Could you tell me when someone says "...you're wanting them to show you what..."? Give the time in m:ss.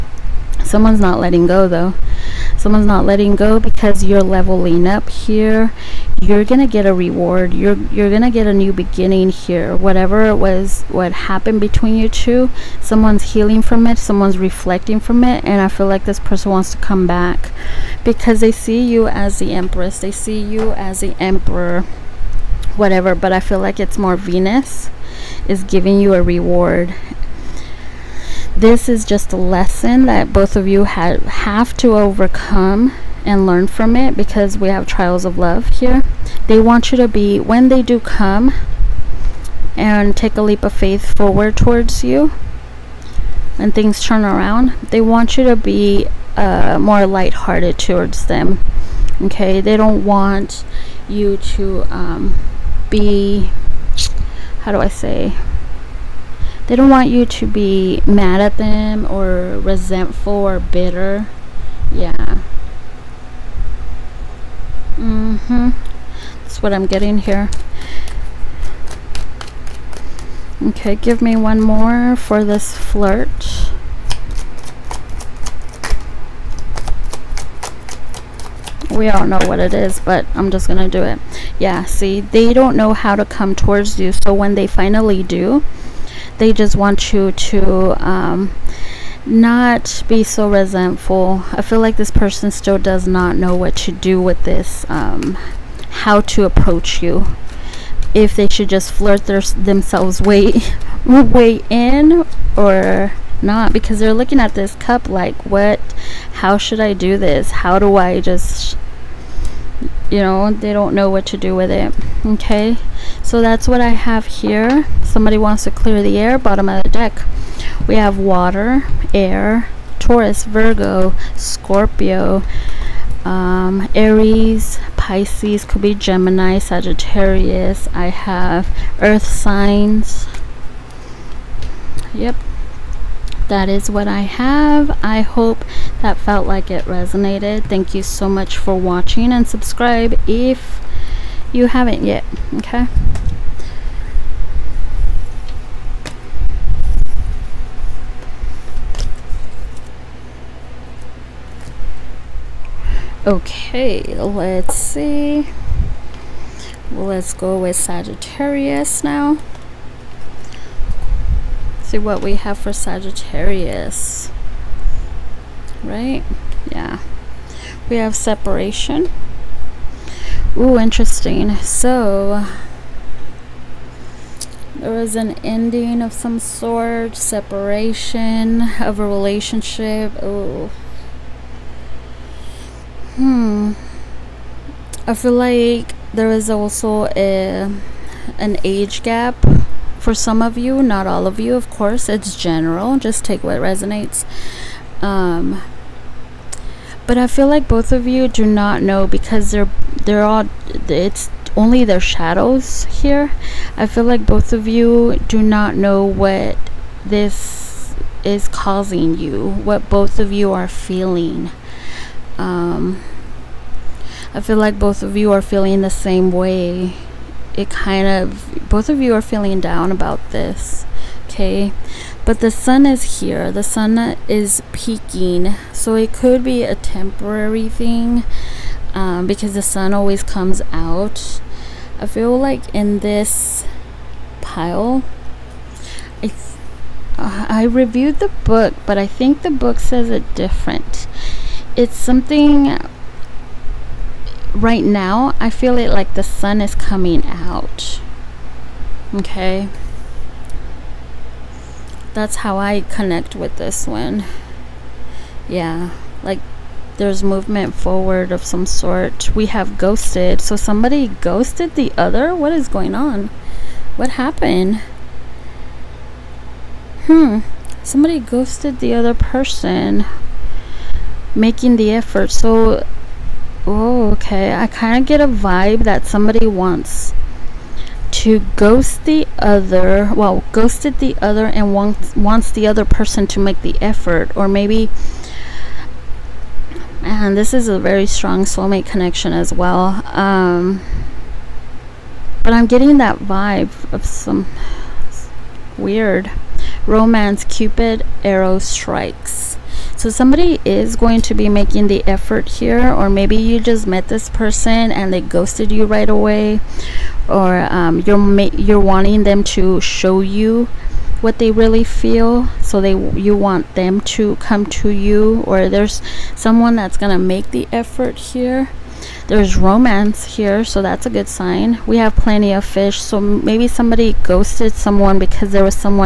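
5:08.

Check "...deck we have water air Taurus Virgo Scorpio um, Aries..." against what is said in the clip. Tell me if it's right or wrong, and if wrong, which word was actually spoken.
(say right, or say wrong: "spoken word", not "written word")
right.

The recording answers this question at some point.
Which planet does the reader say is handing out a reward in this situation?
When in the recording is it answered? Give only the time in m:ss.
0:24.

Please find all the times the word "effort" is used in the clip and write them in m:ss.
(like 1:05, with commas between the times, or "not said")
4:31, 4:43, 5:02, 5:17.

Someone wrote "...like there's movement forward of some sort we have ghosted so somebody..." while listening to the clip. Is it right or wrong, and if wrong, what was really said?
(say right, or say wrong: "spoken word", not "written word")
right.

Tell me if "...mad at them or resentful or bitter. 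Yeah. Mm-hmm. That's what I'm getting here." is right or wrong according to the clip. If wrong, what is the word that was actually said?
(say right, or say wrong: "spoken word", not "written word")
right.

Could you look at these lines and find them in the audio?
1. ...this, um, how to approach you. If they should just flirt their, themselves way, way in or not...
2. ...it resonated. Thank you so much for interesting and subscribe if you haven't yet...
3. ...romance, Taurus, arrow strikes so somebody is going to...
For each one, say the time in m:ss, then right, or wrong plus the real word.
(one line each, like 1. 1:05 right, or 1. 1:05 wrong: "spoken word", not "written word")
1. 1:34 right
2. 2:16 wrong: "watching", not "interesting"
3. 4:56 wrong: "Cupid", not "Taurus".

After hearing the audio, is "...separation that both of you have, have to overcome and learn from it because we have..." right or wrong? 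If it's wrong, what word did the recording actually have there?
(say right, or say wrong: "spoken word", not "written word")
wrong: "lesson", not "separation".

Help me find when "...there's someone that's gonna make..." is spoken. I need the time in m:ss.
5:15.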